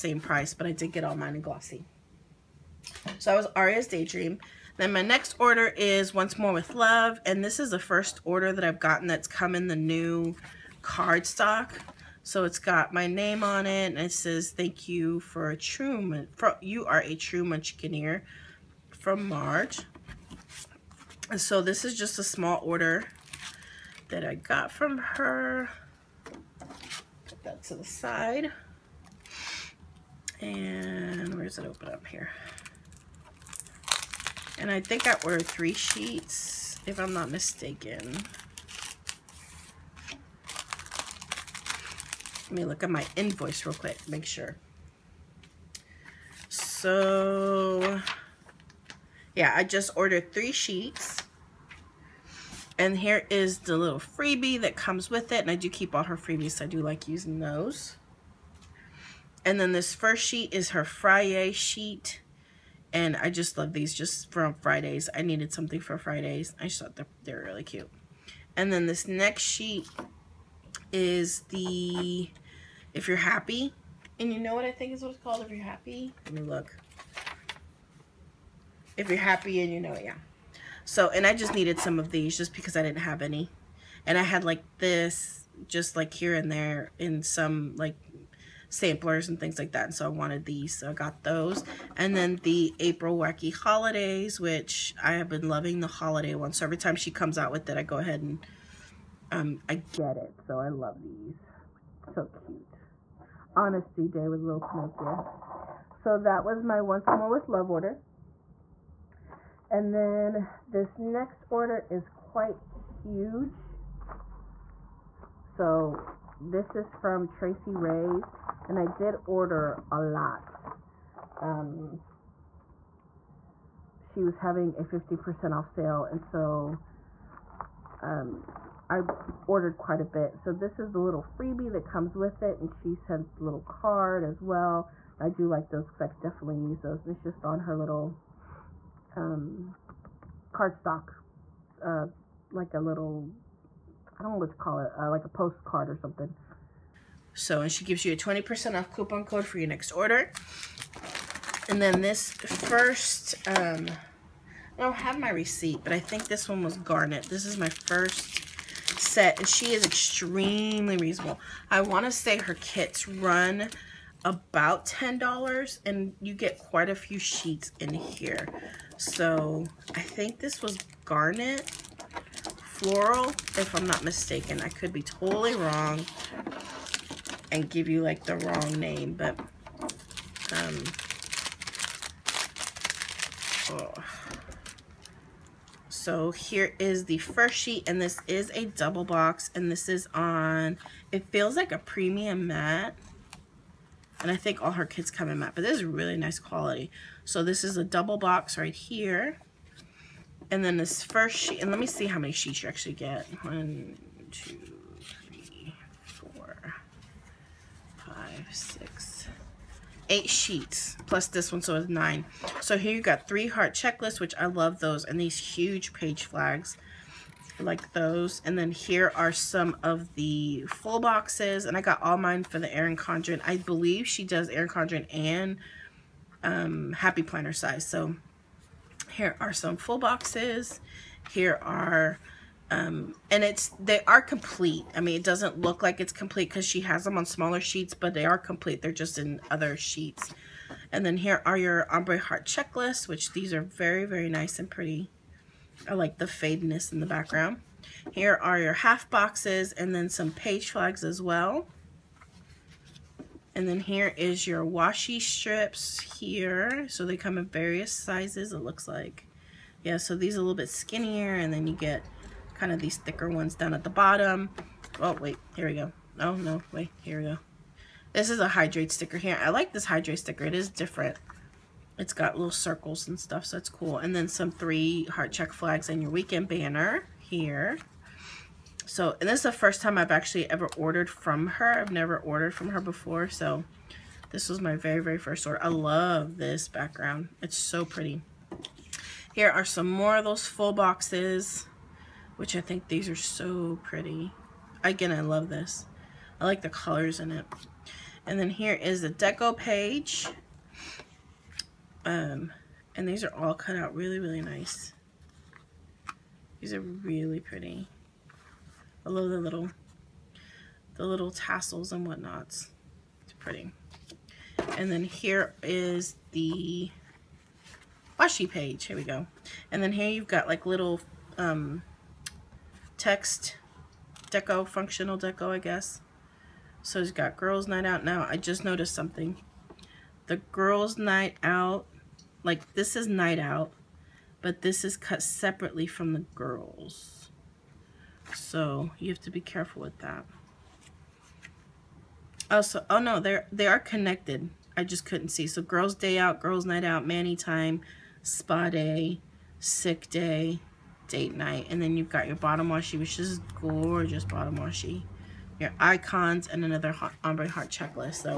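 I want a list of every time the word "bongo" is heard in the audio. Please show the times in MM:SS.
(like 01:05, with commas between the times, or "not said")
not said.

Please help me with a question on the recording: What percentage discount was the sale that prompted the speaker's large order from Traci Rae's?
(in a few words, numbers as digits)
50%.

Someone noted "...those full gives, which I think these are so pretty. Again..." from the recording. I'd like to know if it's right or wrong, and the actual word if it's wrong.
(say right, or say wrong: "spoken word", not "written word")
wrong: "boxes", not "gives".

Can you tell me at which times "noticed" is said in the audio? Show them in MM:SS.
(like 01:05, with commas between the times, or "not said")
05:28.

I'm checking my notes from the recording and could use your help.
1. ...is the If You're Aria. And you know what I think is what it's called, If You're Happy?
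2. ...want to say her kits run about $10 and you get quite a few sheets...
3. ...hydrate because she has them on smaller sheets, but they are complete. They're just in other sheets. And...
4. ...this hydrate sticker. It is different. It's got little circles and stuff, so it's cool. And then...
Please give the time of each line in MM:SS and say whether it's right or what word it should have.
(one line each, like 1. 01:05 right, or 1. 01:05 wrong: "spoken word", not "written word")
1. 01:10 wrong: "Happy", not "Aria"
2. 02:41 right
3. 03:56 wrong: "complete", not "hydrate"
4. 04:29 right.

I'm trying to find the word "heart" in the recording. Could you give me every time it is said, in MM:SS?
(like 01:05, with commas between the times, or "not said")
03:33, 04:02, 04:35, 05:57.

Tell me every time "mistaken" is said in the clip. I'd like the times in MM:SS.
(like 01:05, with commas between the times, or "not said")
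00:37, 02:54.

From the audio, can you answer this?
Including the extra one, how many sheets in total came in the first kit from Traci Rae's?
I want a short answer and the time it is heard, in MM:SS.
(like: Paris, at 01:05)
9, at 03:31.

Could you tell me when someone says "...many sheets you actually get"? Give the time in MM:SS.
03:22.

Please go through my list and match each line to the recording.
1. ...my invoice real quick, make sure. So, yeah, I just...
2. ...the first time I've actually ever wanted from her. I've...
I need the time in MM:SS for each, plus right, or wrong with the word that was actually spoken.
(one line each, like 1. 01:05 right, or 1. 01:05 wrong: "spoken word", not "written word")
1. 00:42 right
2. 04:39 wrong: "ordered", not "wanted".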